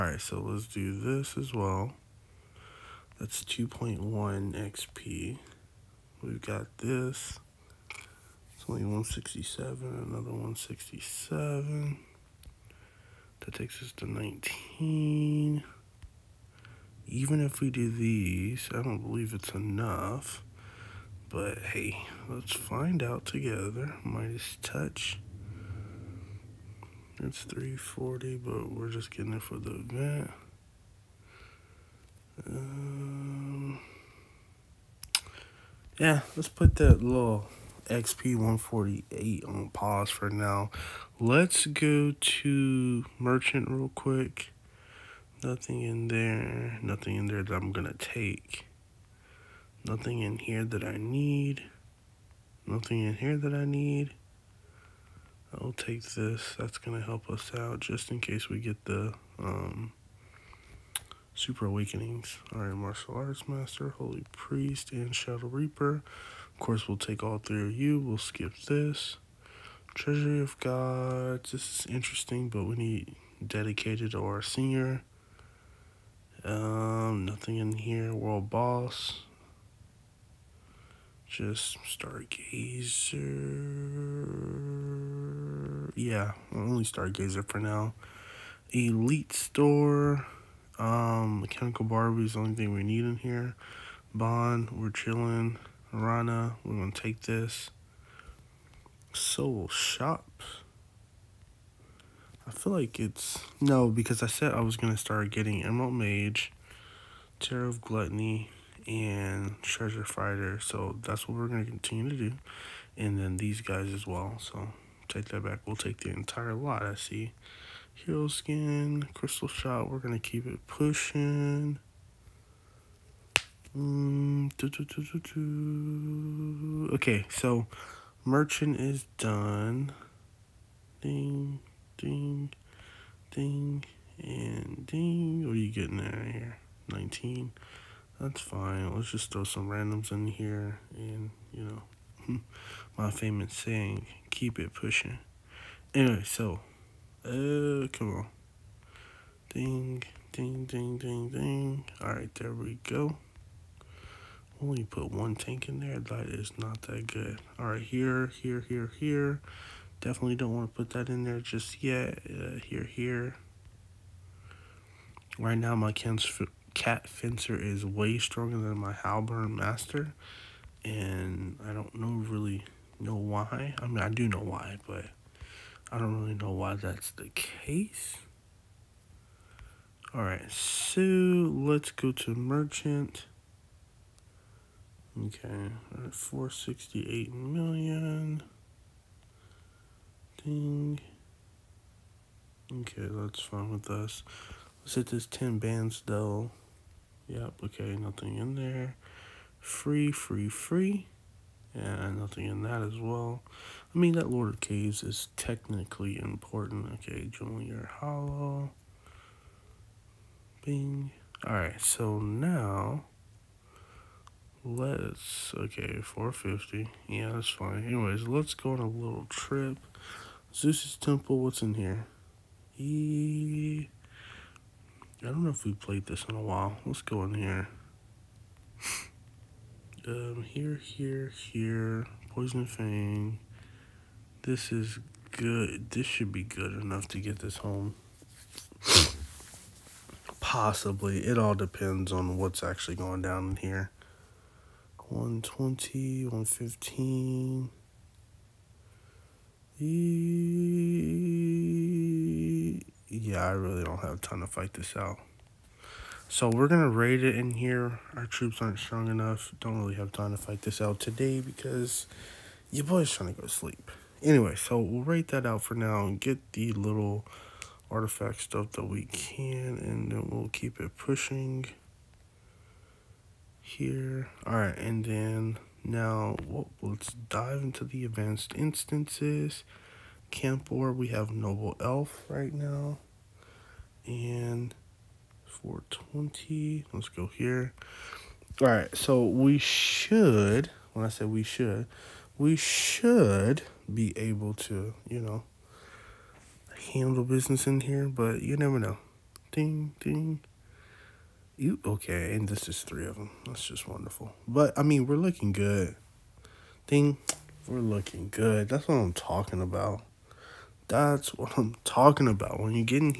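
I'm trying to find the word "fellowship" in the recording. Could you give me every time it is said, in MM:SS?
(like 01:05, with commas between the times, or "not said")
not said.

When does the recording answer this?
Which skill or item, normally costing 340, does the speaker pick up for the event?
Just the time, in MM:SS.
00:24.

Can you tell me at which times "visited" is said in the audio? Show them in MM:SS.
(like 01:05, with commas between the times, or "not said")
not said.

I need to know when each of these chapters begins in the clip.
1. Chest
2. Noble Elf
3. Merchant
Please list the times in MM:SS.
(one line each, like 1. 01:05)
1. 03:03
2. 04:43
3. 00:43.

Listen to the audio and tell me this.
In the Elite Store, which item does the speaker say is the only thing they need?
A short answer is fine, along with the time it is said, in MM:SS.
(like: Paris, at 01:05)
Mechanical Barbie, at 01:31.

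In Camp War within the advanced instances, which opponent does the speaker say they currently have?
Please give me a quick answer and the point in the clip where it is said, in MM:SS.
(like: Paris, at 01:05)
Noble Elf, at 04:41.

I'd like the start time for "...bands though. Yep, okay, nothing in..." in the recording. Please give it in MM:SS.
03:15.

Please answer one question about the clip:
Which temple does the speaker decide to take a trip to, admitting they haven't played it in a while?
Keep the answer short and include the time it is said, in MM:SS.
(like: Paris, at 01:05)
Zeus's temple, at 03:40.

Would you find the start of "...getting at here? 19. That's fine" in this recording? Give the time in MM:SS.
02:15.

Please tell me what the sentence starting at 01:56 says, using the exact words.
I see Hero Skin, Crystal Shot.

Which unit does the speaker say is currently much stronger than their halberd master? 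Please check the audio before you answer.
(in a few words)
Cat fencer.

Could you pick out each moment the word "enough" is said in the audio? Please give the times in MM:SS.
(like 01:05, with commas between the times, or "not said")
00:19, 03:56, 04:19.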